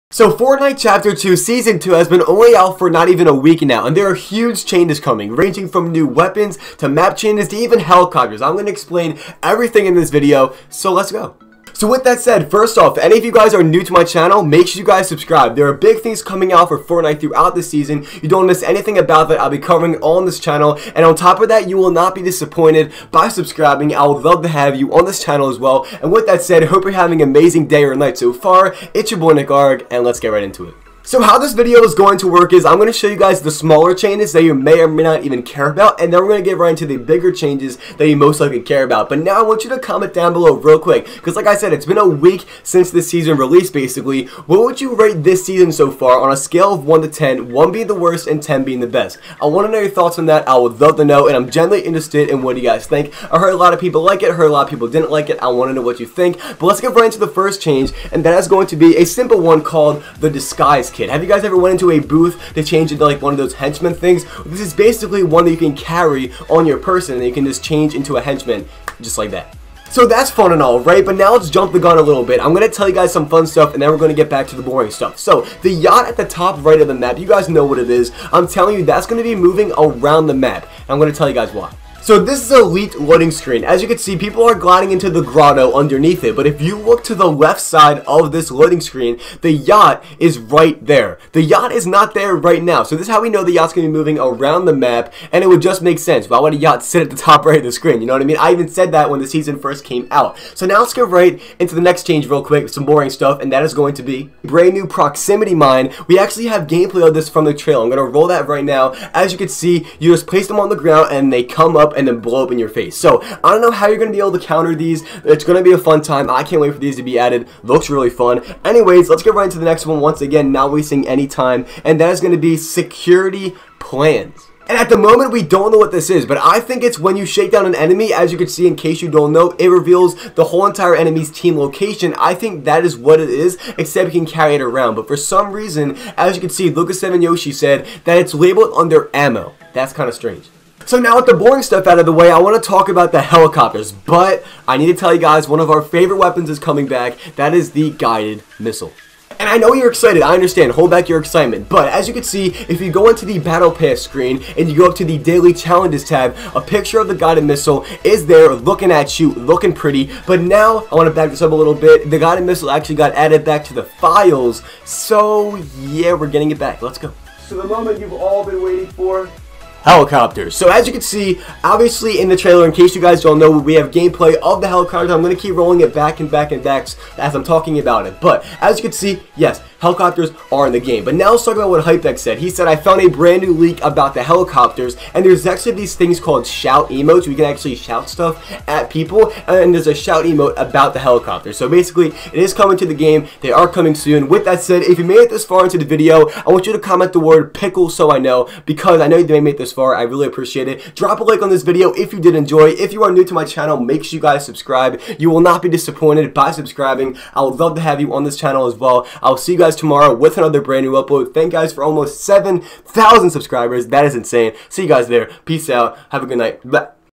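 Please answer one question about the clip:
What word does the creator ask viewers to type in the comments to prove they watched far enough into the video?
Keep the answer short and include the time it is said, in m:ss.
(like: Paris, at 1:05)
pickle, at 3:17.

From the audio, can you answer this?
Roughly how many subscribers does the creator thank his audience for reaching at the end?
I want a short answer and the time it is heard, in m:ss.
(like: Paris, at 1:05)
7,000, at 3:32.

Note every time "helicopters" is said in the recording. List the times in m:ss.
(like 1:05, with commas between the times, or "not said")
0:07, 2:23, 2:49, 2:54, 2:59, 3:04, 3:10.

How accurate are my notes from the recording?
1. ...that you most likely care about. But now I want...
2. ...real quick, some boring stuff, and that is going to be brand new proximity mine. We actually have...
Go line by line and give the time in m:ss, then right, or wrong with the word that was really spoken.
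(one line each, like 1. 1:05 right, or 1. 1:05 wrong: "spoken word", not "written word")
1. 0:37 right
2. 1:42 right.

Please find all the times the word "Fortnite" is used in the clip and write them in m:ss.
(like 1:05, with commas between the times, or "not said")
0:00, 0:16.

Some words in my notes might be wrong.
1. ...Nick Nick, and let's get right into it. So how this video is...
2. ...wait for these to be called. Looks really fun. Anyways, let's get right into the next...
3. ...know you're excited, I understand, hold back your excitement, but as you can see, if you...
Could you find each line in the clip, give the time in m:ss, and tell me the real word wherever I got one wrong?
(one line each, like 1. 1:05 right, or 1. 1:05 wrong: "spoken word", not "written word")
1. 0:29 wrong: "Arg", not "Nick"
2. 1:56 wrong: "added", not "called"
3. 2:29 right.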